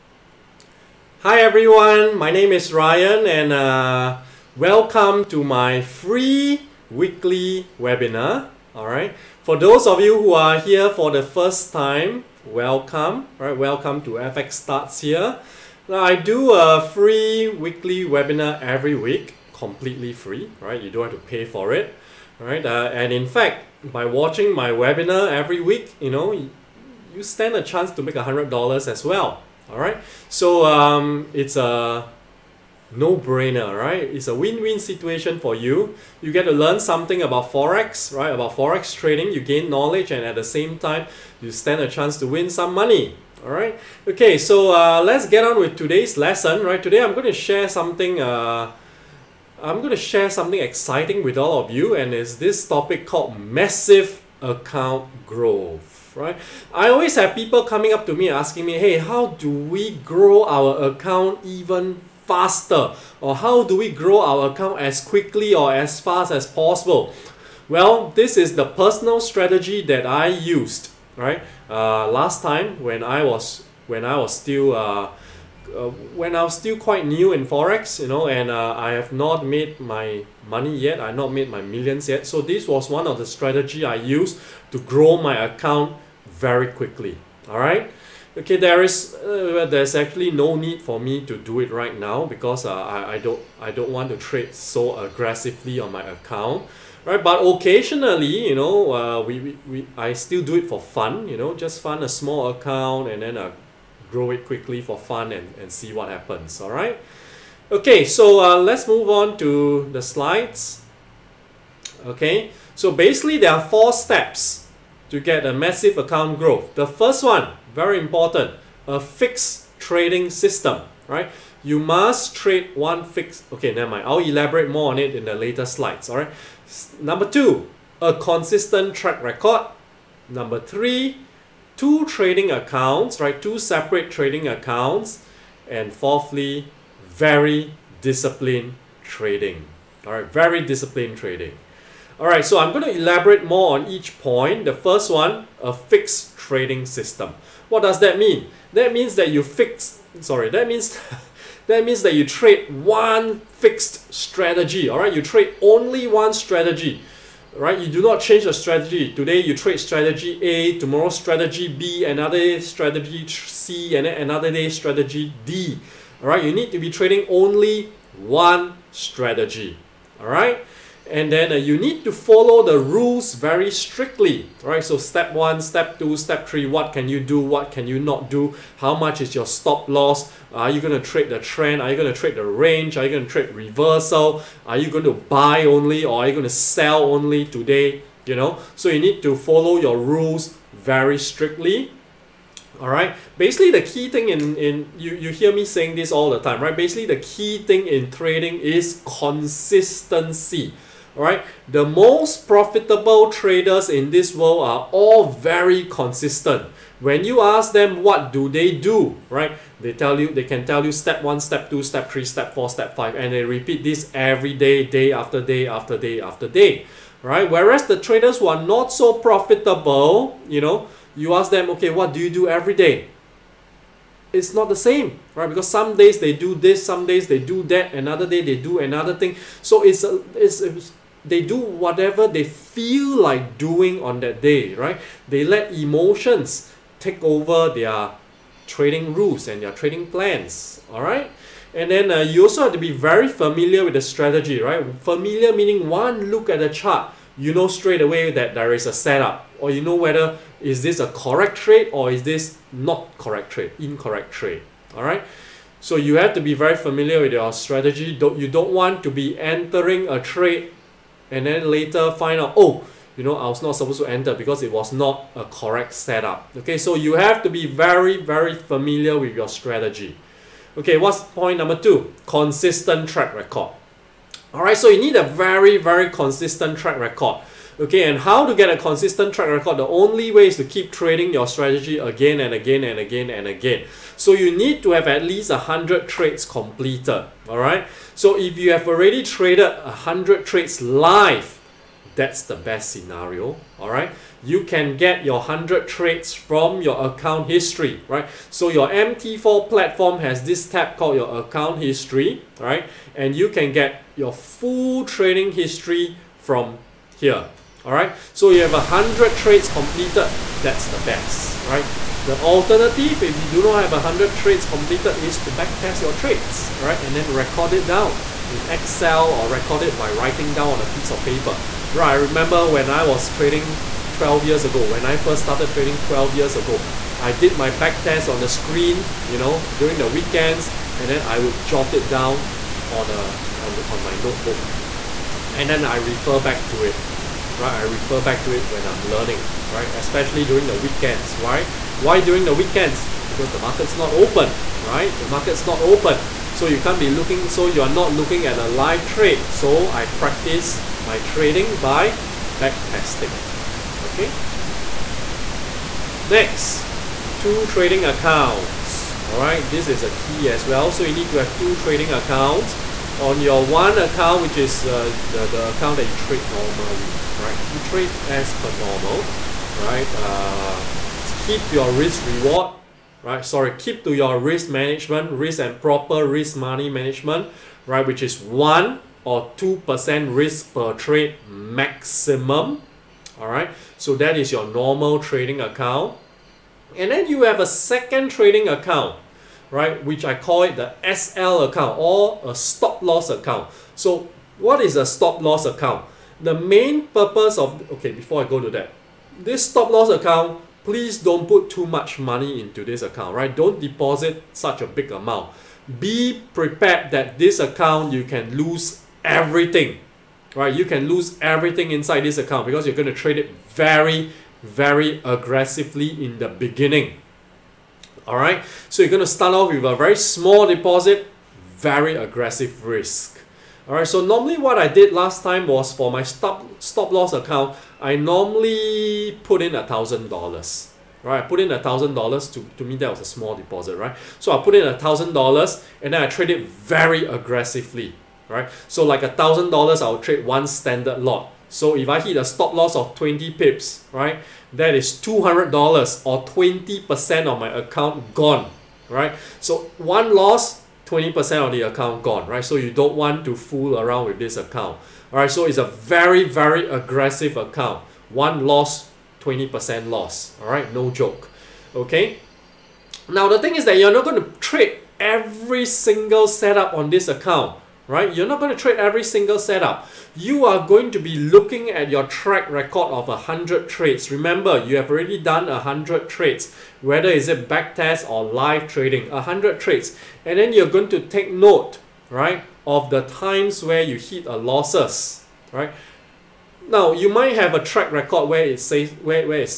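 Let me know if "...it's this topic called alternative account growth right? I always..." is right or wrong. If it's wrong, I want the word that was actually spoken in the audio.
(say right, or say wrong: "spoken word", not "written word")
wrong: "massive", not "alternative".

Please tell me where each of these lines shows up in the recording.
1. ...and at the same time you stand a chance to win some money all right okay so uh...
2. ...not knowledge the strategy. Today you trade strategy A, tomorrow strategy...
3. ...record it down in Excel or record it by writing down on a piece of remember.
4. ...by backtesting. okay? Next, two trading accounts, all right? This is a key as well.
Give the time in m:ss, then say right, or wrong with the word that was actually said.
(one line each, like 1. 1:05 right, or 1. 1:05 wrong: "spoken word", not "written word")
1. 0:40 right
2. 2:38 wrong: "change", not "knowledge"
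3. 5:17 wrong: "paper", not "remember"
4. 5:51 right.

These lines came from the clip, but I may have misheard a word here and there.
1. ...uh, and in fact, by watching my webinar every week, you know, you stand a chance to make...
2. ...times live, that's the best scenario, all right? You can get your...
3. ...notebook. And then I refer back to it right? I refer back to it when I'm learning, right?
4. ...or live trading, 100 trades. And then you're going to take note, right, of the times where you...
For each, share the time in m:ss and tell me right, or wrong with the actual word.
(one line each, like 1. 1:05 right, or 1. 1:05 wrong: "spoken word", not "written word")
1. 0:22 right
2. 4:50 wrong: "trades", not "times"
3. 5:34 right
4. 7:58 right.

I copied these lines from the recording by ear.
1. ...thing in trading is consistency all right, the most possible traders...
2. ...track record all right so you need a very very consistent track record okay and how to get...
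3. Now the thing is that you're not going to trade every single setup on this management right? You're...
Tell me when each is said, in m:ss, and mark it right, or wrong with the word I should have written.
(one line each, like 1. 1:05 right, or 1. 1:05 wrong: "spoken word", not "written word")
1. 3:17 wrong: "profitable", not "possible"
2. 4:33 right
3. 7:43 wrong: "account", not "management".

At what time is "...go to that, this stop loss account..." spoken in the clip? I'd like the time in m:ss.
6:38.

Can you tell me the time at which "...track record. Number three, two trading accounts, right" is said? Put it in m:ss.
2:08.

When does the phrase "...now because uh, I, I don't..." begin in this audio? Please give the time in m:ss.
1:31.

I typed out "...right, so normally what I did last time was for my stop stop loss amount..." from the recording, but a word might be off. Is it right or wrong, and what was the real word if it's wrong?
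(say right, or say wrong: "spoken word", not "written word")
wrong: "account", not "amount".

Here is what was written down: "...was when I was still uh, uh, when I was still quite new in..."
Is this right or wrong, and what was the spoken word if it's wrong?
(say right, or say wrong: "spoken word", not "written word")
right.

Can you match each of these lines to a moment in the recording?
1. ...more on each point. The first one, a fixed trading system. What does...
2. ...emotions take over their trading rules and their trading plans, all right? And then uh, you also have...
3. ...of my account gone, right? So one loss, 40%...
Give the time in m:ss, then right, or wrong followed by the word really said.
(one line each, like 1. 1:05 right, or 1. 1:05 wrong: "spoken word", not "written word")
1. 2:23 right
2. 3:55 right
3. 7:27 wrong: "20", not "40".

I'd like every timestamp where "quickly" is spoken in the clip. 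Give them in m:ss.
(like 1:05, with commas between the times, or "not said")
1:05, 1:26, 1:44.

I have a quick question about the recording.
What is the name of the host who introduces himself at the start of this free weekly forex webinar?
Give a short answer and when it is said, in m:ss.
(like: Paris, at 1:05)
Ryan, at 0:02.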